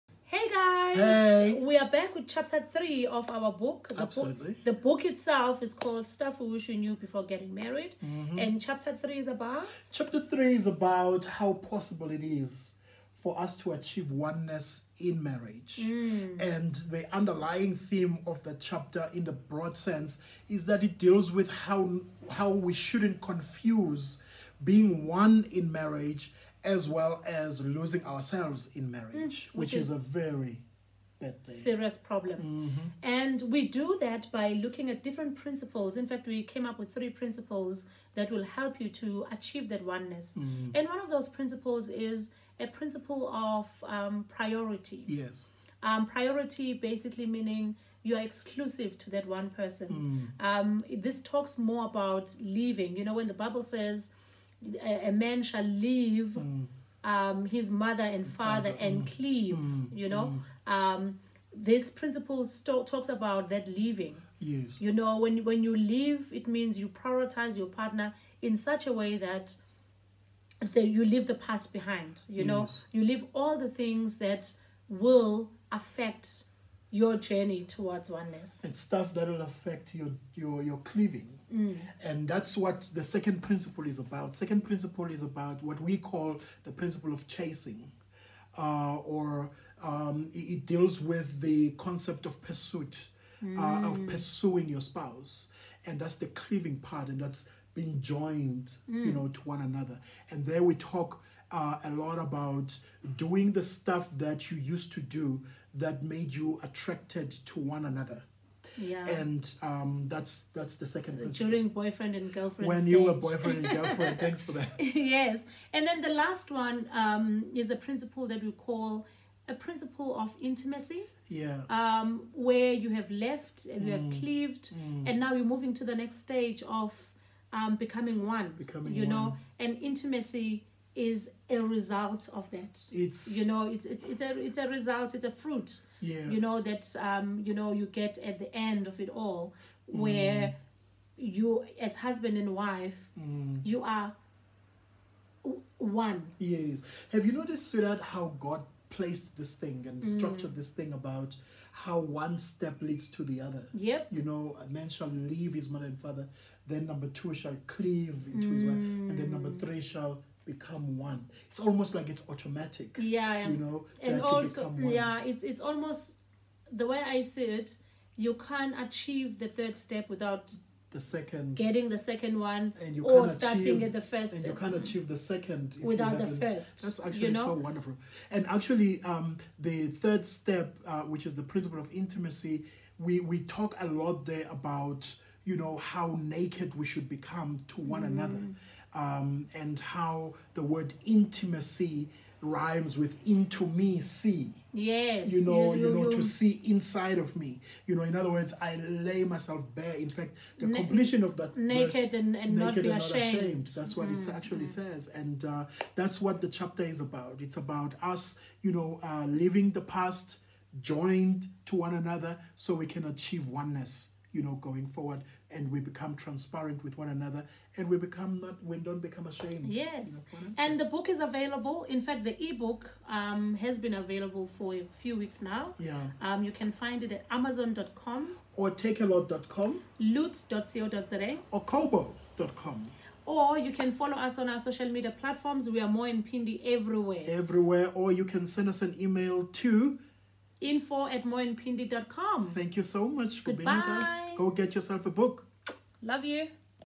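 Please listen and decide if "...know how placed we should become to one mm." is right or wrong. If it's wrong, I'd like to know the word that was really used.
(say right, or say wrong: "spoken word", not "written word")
wrong: "naked", not "placed".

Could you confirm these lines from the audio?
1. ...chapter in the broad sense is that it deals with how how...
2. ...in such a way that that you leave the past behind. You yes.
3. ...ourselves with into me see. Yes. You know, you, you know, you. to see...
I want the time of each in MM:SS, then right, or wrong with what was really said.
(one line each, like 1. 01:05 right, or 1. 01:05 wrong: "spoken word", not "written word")
1. 00:18 right
2. 01:08 right
3. 03:12 wrong: "rhymes", not "ourselves".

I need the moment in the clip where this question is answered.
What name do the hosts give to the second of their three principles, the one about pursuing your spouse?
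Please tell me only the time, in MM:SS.
01:26.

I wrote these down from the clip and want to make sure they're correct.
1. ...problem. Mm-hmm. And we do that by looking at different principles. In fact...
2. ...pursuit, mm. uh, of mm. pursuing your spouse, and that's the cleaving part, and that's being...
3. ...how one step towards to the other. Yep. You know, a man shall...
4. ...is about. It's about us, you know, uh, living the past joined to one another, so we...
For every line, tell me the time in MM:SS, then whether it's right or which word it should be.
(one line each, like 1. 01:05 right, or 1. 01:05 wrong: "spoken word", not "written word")
1. 00:31 right
2. 01:32 right
3. 02:31 wrong: "leads", not "towards"
4. 03:26 right.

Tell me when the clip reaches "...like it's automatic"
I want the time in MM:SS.
02:41.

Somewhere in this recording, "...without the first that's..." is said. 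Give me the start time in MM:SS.
02:55.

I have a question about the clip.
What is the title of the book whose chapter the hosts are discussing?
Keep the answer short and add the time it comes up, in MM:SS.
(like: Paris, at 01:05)
Stuff We Wish We Knew Before Getting Married, at 00:06.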